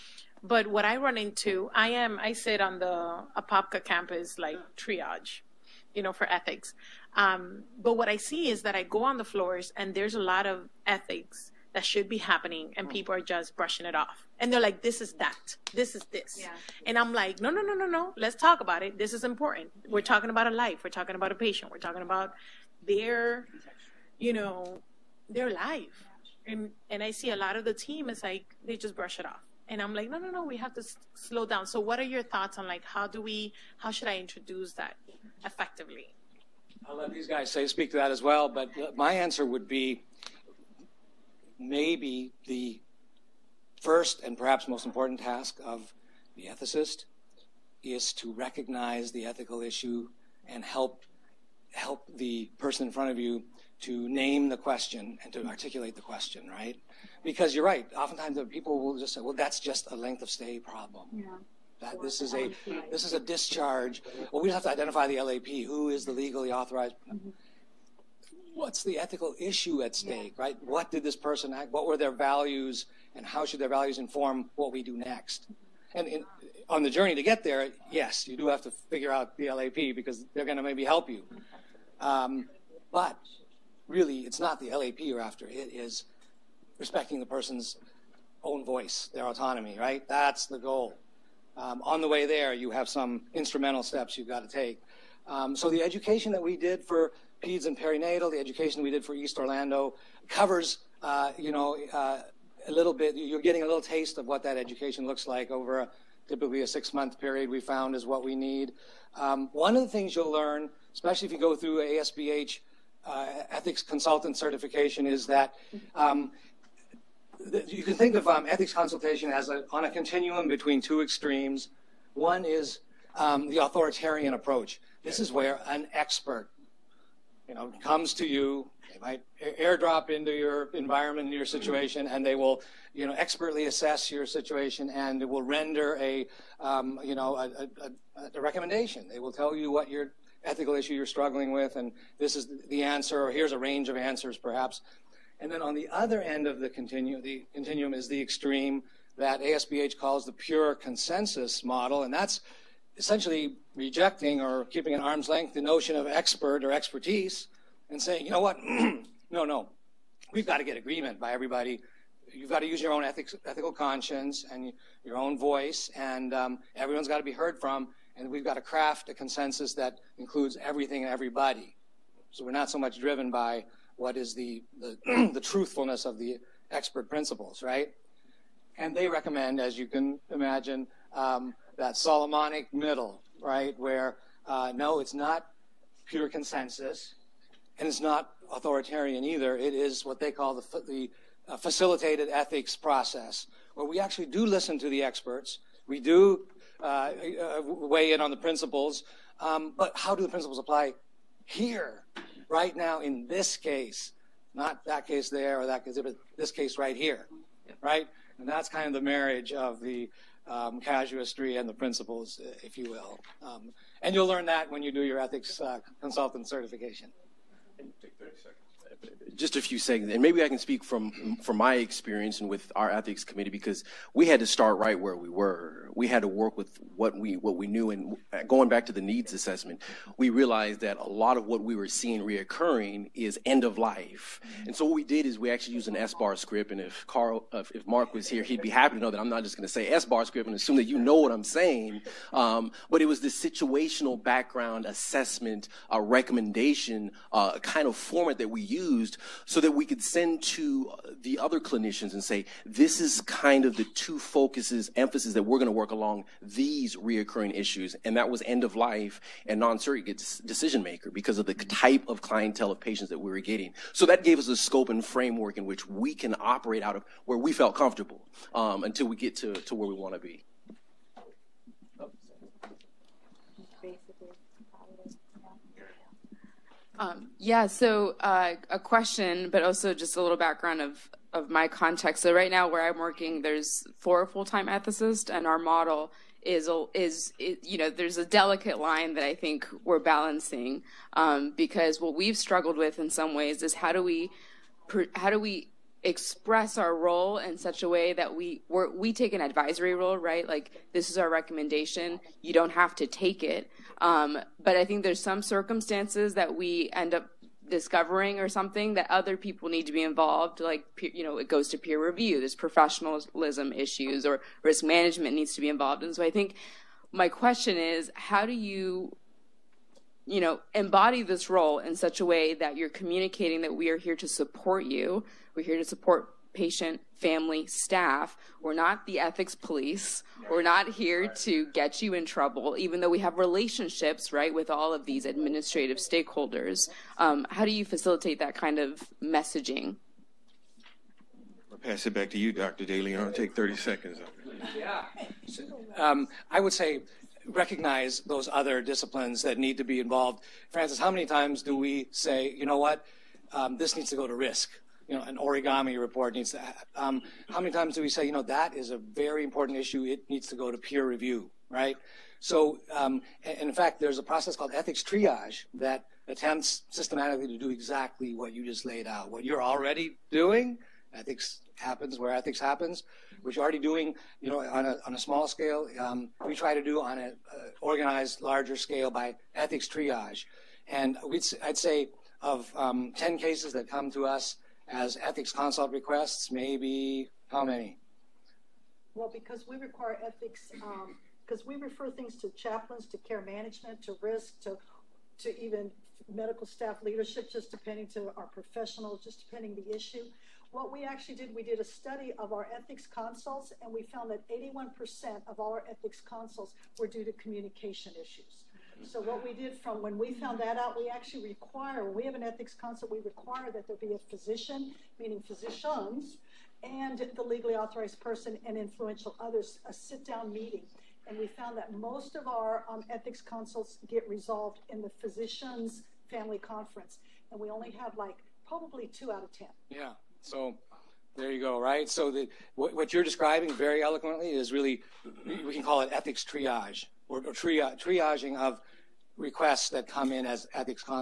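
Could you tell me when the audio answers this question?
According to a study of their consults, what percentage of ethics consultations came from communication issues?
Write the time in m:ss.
6:44.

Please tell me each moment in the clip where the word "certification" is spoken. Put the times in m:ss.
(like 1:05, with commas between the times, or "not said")
1:54, 3:36.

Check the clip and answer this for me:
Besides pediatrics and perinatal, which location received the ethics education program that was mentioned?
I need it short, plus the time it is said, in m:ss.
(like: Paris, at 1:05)
East Orlando, at 1:39.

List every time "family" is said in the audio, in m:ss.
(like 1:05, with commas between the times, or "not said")
5:27, 7:06.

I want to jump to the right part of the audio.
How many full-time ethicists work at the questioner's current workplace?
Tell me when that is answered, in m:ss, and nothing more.
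4:43.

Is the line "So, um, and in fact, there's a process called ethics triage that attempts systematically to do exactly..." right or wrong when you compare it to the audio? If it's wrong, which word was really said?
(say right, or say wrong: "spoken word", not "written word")
right.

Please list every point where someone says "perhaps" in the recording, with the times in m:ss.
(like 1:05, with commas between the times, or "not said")
0:44, 2:24.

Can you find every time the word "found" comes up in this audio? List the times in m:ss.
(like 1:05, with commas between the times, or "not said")
1:47, 6:44, 6:50, 7:01.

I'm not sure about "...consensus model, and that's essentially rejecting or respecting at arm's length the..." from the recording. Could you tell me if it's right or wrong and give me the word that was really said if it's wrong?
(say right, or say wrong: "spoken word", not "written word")
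wrong: "keeping", not "respecting".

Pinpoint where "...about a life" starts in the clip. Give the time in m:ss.
0:20.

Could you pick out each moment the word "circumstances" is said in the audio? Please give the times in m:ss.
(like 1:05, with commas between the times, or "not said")
5:05.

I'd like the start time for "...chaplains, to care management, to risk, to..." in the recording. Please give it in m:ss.
6:32.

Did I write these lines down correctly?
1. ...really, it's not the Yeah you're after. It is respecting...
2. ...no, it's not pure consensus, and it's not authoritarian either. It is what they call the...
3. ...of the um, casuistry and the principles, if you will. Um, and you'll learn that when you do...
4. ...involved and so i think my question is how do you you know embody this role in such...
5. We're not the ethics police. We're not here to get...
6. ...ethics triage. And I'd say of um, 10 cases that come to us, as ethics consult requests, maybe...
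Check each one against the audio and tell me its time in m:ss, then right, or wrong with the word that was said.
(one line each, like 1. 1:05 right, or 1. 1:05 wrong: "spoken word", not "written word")
1. 1:23 wrong: "LAP", not "Yeah"
2. 3:04 right
3. 3:29 right
4. 5:15 right
5. 5:28 right
6. 6:19 right.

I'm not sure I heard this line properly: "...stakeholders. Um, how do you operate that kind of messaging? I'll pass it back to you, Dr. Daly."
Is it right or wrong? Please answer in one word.
wrong.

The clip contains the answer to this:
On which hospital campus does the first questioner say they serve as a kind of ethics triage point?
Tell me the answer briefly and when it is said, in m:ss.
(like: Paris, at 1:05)
Apopka, at 0:03.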